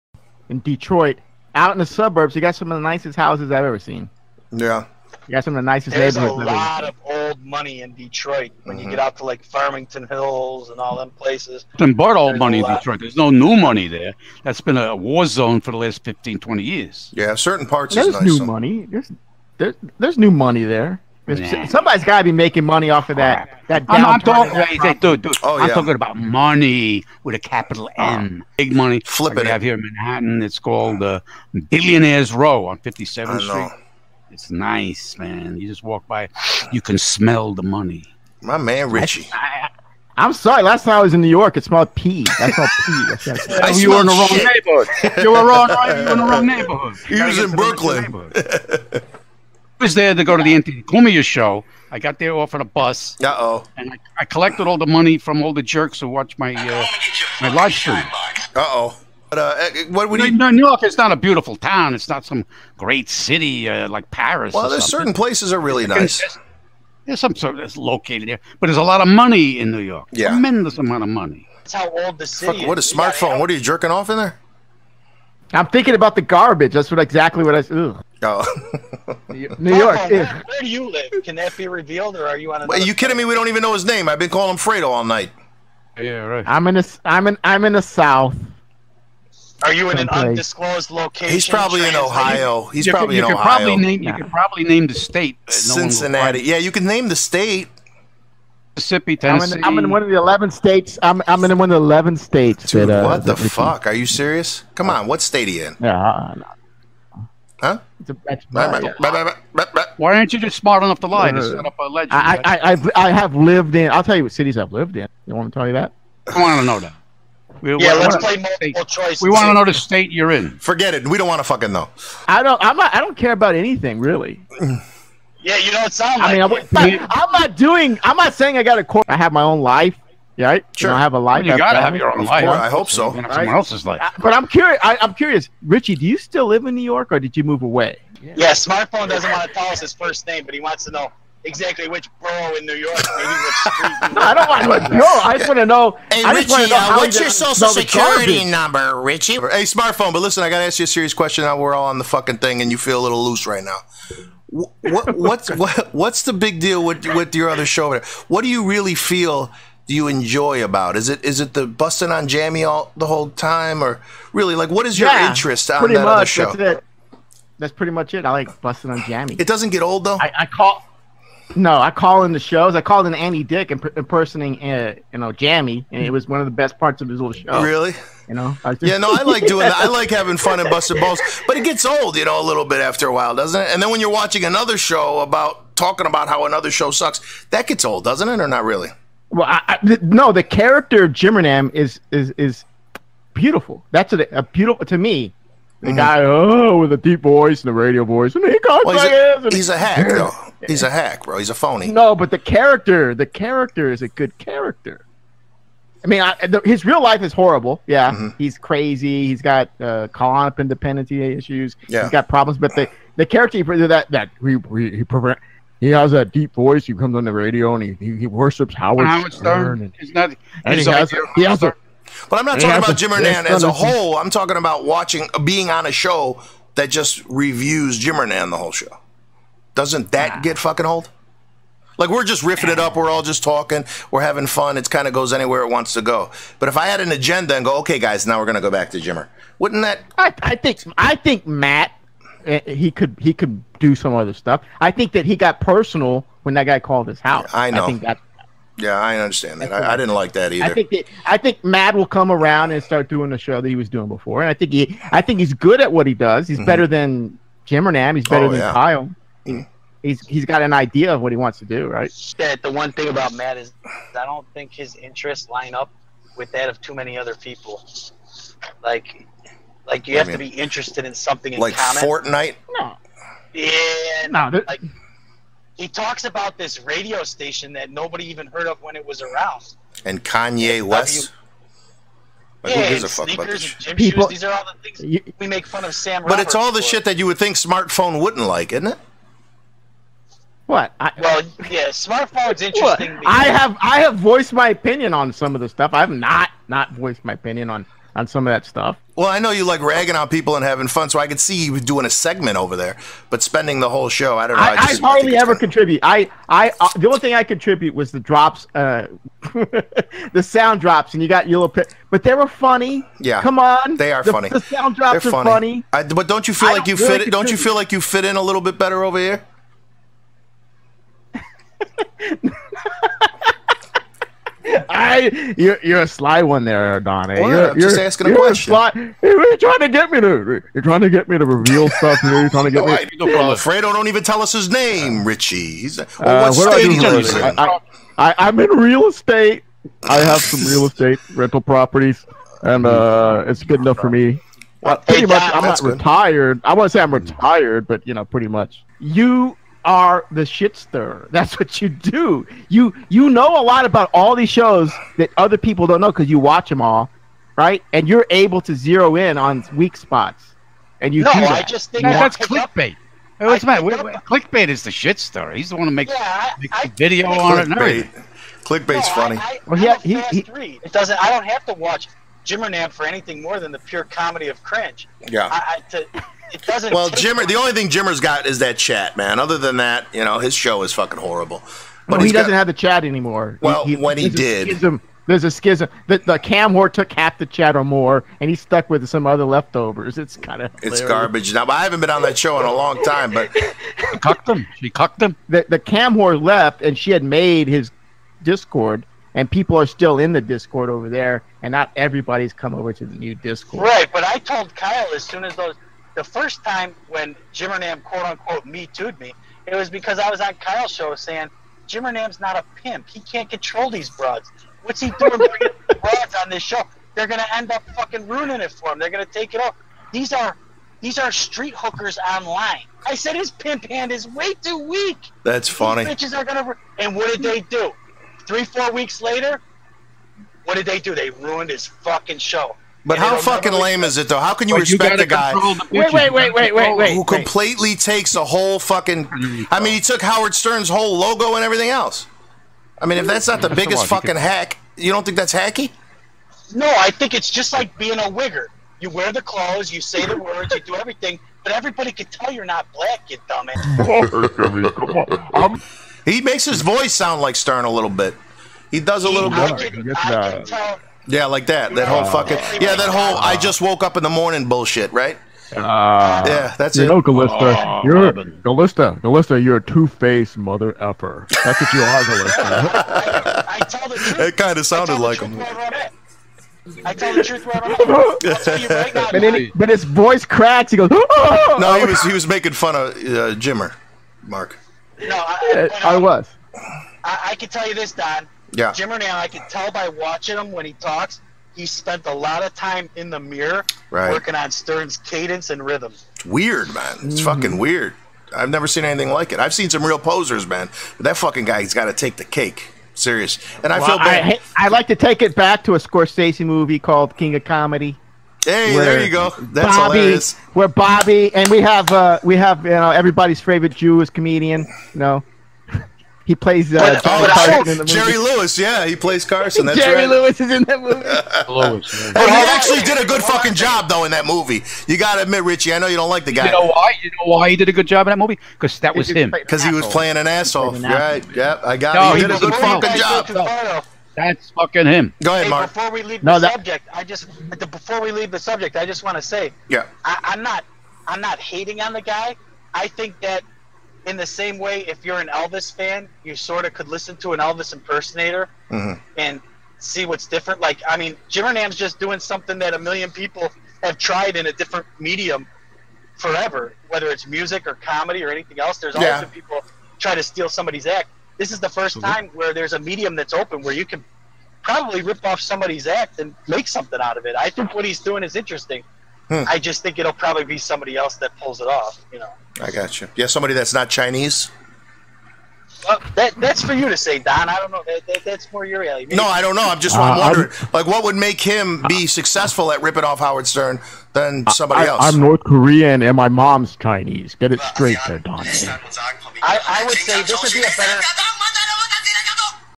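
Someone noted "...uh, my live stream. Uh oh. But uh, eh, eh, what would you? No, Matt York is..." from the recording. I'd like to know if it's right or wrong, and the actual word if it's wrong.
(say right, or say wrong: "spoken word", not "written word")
wrong: "New", not "Matt".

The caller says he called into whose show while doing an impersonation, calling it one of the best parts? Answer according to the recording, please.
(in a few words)
Andy Dick.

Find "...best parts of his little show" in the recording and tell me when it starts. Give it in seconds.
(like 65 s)
176 s.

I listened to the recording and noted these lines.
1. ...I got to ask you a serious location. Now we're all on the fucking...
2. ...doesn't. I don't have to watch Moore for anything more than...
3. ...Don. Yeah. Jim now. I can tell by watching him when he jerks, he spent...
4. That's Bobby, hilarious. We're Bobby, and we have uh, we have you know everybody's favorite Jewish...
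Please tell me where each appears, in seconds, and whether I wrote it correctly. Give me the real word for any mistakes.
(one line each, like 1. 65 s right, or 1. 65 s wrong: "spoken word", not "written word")
1. 150 s wrong: "question", not "location"
2. 370 s wrong: "Jimmernam", not "Moore"
3. 488 s wrong: "talks", not "jerks"
4. 509 s right.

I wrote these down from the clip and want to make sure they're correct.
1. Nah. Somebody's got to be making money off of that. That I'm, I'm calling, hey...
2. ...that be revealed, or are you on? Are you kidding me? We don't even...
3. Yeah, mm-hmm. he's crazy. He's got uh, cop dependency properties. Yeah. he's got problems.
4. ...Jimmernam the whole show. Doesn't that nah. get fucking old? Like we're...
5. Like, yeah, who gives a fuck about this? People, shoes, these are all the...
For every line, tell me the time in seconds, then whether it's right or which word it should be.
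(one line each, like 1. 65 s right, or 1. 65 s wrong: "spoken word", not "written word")
1. 21 s wrong: "talking", not "calling"
2. 81 s right
3. 207 s wrong: "issues", not "properties"
4. 227 s right
5. 282 s right.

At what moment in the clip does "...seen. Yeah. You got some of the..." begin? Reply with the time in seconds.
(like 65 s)
3 s.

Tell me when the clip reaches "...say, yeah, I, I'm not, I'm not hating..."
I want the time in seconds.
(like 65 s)
539 s.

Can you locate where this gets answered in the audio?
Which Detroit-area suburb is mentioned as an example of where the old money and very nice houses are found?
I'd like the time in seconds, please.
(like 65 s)
9 s.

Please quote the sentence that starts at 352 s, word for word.
You you know a lot about all these shows that other people don't know because you watch them all, right?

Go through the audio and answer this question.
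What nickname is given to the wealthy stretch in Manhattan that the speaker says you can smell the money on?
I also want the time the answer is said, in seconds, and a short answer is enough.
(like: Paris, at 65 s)
Billionaires Row, at 31 s.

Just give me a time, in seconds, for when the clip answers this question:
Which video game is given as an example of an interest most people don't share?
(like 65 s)
272 s.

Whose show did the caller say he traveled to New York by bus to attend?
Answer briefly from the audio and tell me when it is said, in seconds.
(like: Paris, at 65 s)
Anthony Cumia, at 50 s.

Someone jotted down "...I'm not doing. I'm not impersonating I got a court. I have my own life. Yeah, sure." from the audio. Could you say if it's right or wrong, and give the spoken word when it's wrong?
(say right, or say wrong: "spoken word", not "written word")
wrong: "saying", not "impersonating".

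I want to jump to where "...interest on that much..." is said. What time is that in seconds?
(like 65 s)
165 s.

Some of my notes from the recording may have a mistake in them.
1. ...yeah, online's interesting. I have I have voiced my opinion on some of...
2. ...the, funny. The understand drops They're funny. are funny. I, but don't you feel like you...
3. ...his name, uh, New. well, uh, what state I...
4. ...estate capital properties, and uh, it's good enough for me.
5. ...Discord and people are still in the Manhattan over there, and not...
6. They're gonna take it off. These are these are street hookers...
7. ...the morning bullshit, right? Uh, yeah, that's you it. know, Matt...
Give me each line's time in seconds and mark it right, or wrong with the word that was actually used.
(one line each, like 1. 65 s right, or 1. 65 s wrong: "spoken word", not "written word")
1. 291 s wrong: "smartphone", not "online"
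2. 314 s wrong: "sound", not "understand"
3. 334 s wrong: "Richie", not "New"
4. 340 s wrong: "rental", not "capital"
5. 398 s wrong: "Discord", not "Manhattan"
6. 418 s right
7. 464 s wrong: "Galista", not "Matt".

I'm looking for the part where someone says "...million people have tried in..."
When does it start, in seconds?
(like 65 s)
552 s.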